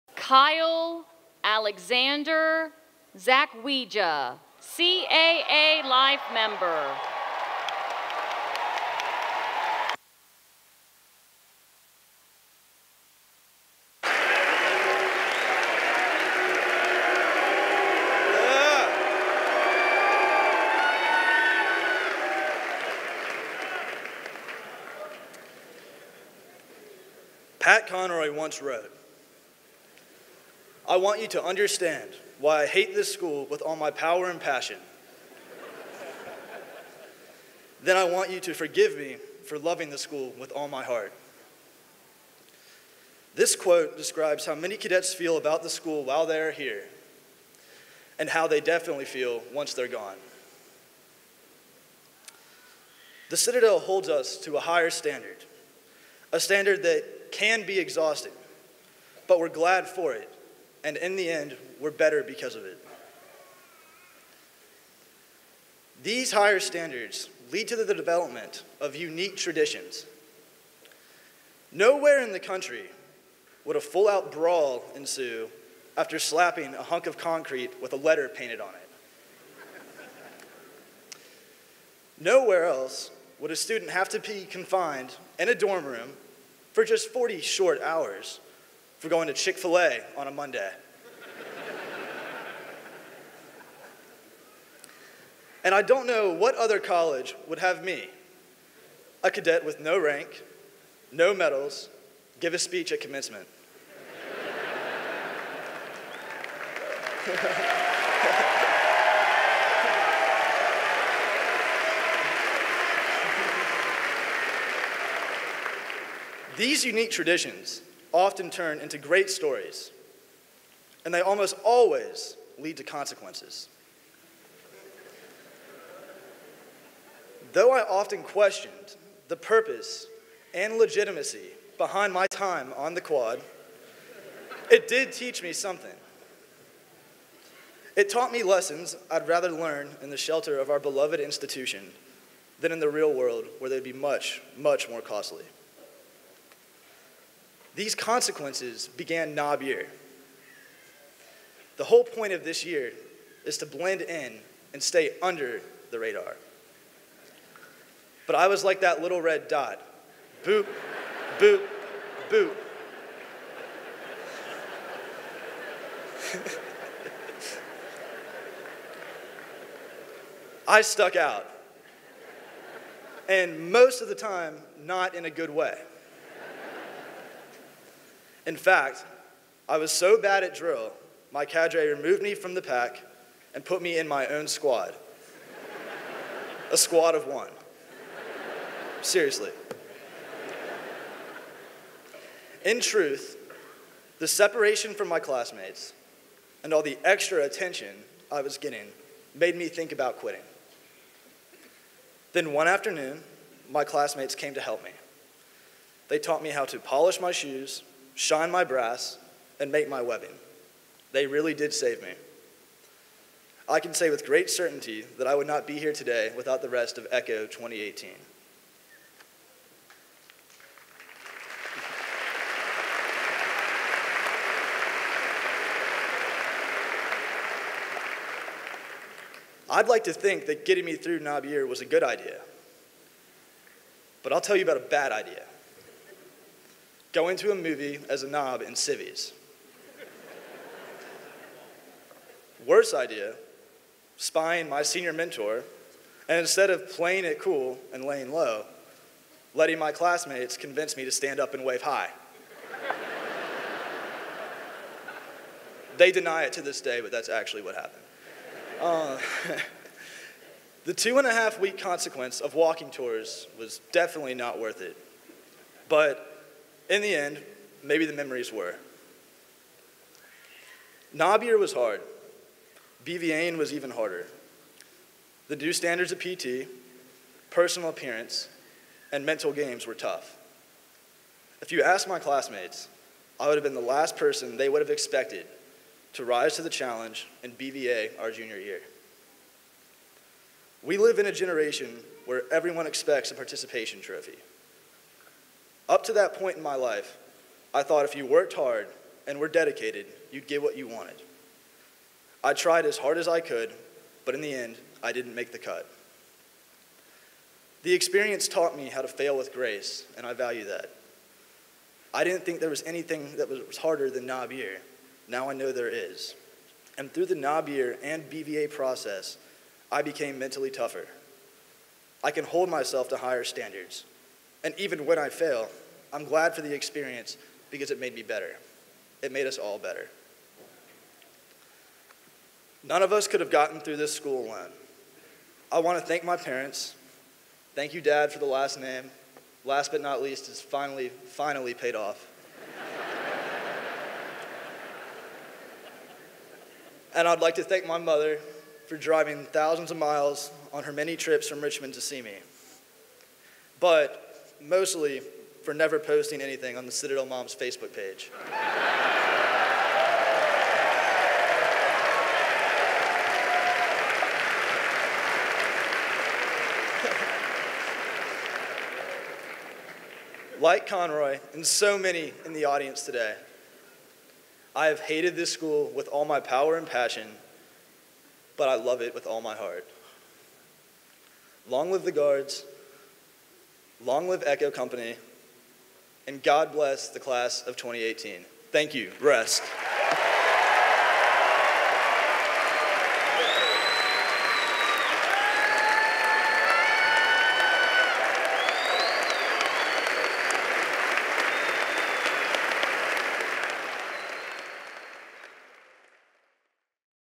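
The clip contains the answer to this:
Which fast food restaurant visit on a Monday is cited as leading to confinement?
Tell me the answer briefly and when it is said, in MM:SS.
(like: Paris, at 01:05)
Chick fil A, at 01:29.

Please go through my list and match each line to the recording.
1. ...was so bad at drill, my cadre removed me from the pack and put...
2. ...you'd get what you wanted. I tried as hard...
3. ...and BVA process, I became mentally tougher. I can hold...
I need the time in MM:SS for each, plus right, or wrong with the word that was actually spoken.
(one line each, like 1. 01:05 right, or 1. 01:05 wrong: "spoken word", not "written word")
1. 02:59 right
2. 05:00 right
3. 05:18 right.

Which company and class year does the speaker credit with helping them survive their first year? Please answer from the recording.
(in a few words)
Echo 2018.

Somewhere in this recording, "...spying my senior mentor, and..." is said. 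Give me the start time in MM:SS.
04:04.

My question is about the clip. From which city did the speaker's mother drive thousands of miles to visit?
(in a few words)
Richmond.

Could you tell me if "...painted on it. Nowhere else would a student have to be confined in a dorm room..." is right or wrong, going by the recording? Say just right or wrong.
right.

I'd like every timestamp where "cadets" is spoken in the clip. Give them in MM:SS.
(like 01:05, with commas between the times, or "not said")
00:44, 01:39.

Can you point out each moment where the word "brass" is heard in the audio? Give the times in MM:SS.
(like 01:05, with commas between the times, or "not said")
03:28.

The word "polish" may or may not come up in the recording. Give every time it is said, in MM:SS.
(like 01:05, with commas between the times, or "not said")
03:26.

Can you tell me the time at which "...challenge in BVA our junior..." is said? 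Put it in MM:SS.
04:46.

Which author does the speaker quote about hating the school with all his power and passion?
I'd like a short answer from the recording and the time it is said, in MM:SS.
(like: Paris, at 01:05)
Pat Conroy, at 00:27.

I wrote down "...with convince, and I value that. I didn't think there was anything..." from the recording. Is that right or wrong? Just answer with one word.
wrong.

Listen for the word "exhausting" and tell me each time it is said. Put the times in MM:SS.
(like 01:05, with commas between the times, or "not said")
00:57.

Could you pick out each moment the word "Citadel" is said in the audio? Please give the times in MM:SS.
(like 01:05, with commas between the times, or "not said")
00:53, 05:56.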